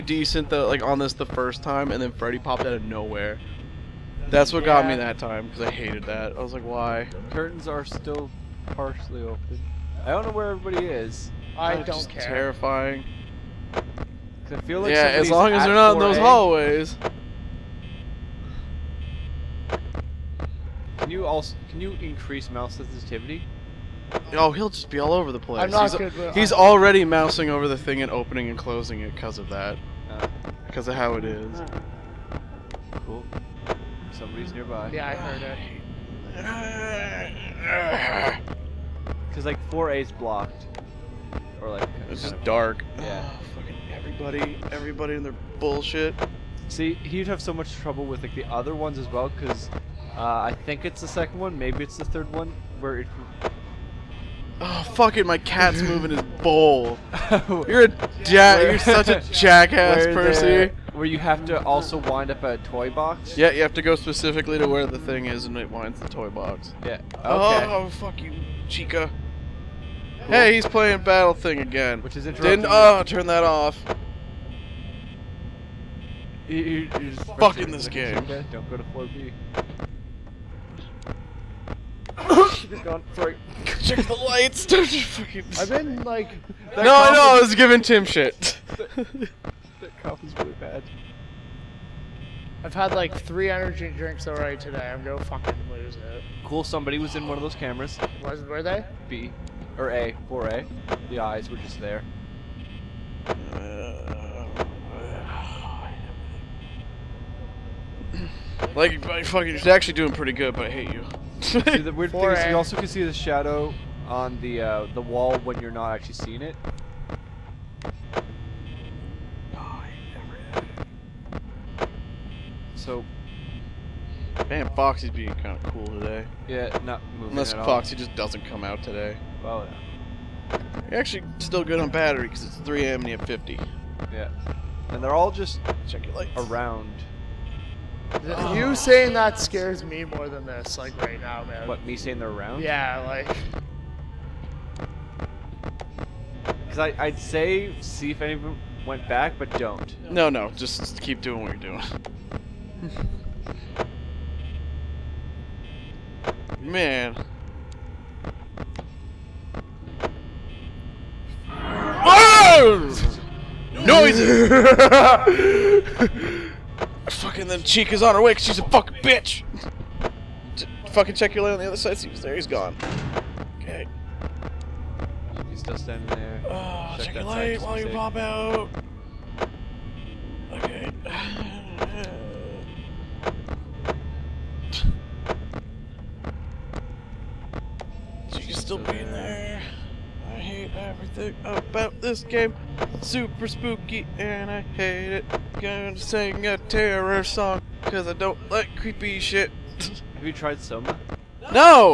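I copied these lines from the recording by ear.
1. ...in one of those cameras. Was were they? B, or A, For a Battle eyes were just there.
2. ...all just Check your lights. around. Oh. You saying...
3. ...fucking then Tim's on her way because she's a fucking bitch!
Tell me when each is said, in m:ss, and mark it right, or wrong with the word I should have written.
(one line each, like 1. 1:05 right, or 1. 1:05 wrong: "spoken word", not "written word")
1. 1:37 wrong: "The", not "Battle"
2. 2:15 right
3. 2:47 wrong: "Chica", not "Tim".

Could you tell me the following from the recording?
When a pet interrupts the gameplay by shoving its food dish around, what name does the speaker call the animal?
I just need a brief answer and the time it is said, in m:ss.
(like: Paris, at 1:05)
Percy, at 1:00.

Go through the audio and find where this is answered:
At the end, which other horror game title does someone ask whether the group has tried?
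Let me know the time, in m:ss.
3:20.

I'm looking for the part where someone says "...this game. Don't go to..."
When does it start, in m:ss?
1:17.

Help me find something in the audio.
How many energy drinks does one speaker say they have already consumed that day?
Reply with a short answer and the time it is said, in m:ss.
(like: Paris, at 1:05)
3, at 1:33.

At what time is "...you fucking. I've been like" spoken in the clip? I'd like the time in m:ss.
1:24.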